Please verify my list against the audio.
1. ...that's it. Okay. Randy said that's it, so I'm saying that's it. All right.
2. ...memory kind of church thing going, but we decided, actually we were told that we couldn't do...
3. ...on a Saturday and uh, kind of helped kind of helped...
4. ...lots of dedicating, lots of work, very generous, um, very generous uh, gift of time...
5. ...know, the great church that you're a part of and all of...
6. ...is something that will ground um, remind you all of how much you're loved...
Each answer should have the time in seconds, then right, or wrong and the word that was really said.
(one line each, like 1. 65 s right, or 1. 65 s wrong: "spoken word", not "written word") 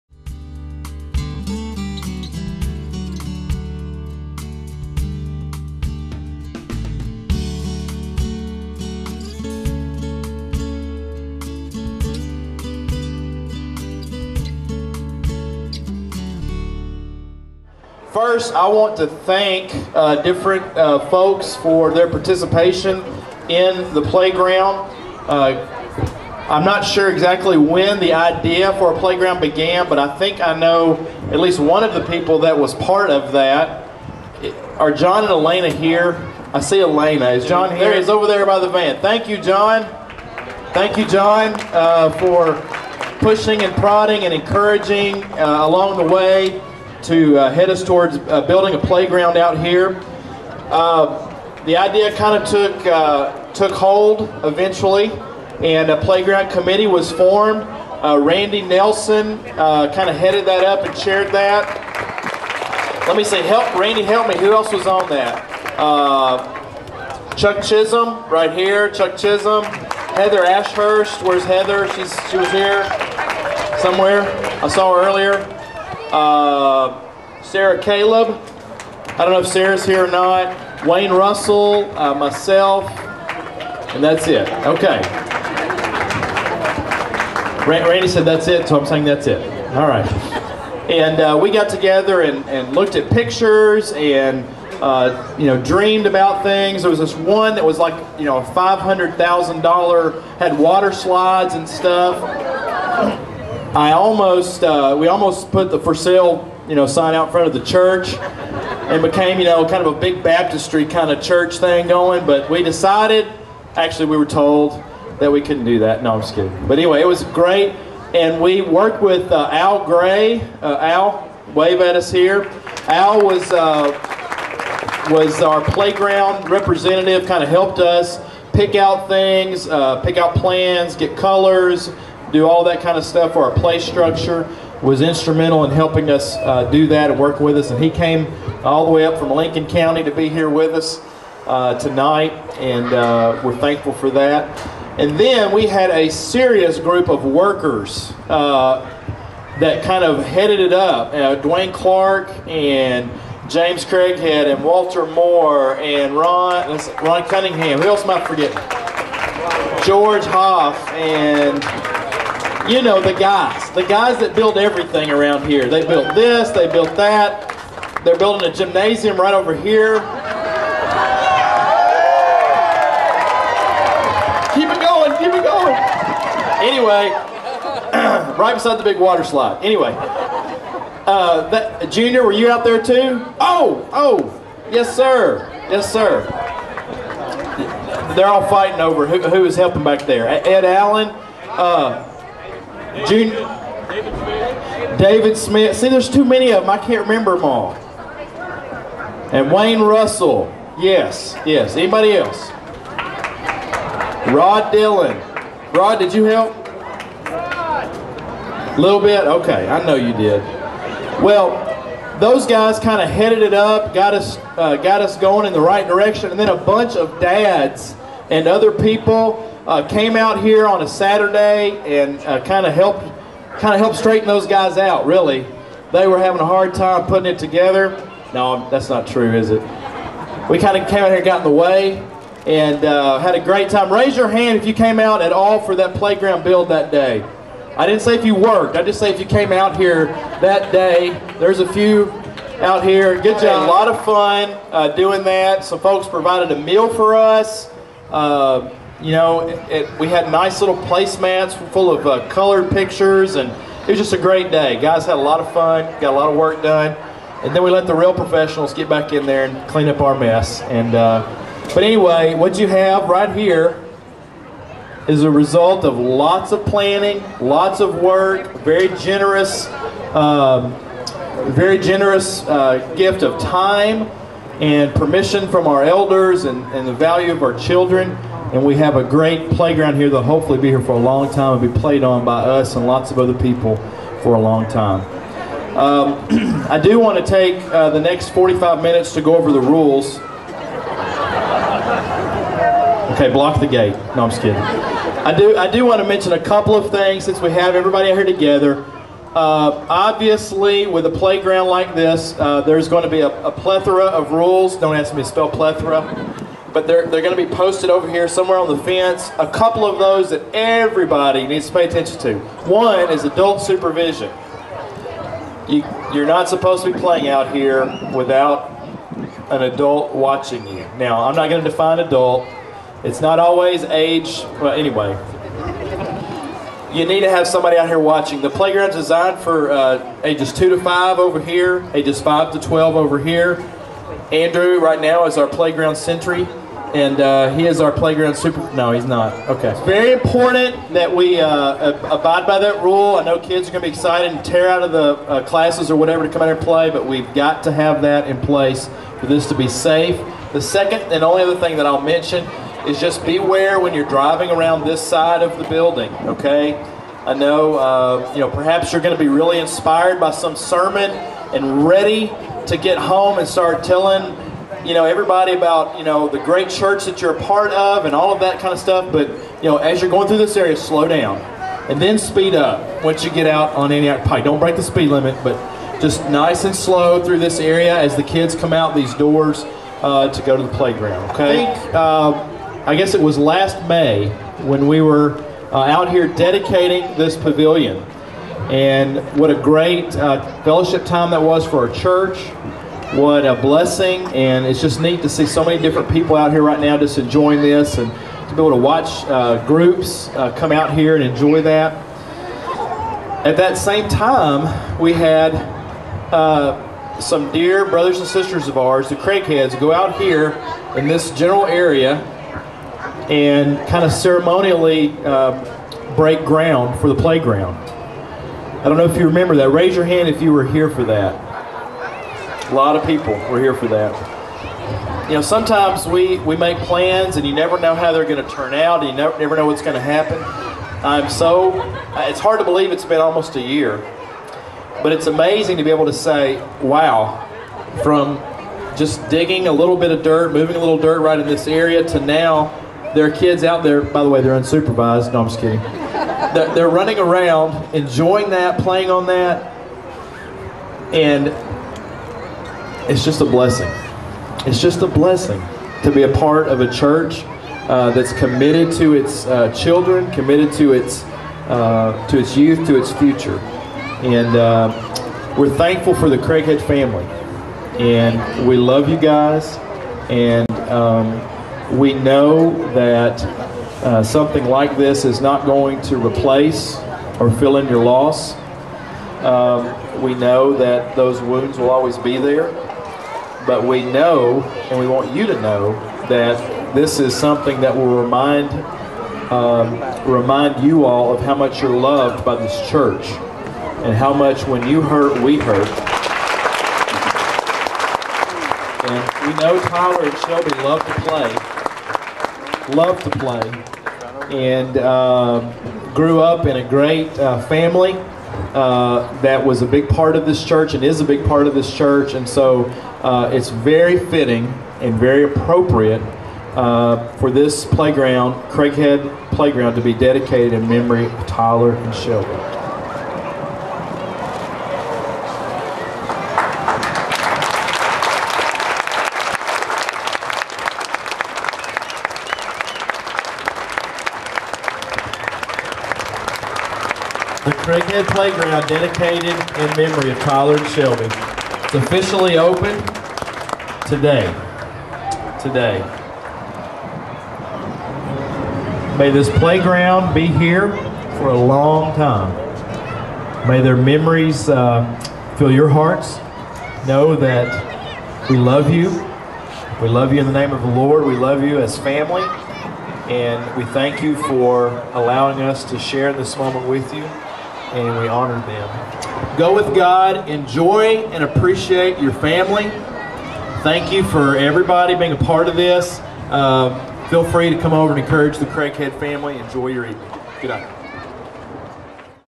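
1. 84 s right
2. 110 s wrong: "baptistry", not "memory"
3. 220 s right
4. 265 s wrong: "planning", not "dedicating"
5. 366 s right
6. 487 s wrong: "remind", not "ground".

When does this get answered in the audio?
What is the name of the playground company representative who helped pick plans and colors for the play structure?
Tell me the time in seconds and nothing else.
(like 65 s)
119 s.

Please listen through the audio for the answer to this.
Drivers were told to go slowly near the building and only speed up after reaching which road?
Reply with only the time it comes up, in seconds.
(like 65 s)
373 s.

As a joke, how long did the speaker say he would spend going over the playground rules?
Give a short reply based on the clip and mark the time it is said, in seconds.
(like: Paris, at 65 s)
45 minutes, at 288 s.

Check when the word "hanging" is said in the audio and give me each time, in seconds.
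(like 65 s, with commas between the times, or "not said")
not said.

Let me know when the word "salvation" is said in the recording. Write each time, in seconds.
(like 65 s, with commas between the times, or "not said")
not said.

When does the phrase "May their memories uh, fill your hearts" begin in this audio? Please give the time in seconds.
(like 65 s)
553 s.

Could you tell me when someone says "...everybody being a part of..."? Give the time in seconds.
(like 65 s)
574 s.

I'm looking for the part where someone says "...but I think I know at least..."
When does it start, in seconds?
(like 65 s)
29 s.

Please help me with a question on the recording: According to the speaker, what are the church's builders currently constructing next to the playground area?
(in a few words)
a gymnasium.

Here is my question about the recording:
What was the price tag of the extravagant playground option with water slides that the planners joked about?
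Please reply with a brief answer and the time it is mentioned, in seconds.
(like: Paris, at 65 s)
$500,000, at 98 s.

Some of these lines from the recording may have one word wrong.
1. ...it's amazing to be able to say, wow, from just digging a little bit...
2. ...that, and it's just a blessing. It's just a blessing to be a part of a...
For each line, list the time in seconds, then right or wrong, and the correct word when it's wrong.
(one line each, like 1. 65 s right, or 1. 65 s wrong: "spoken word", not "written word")
1. 435 s right
2. 449 s right.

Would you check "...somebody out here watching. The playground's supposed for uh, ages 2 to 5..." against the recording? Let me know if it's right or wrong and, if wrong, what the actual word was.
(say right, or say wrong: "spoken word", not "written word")
wrong: "designed", not "supposed".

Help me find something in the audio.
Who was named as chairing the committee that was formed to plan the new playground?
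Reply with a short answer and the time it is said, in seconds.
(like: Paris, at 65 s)
Randy Nelson, at 58 s.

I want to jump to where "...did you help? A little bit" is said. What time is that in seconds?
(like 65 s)
205 s.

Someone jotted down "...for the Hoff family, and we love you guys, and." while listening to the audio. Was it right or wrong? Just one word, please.
wrong.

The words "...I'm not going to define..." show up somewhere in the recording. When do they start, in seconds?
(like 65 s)
321 s.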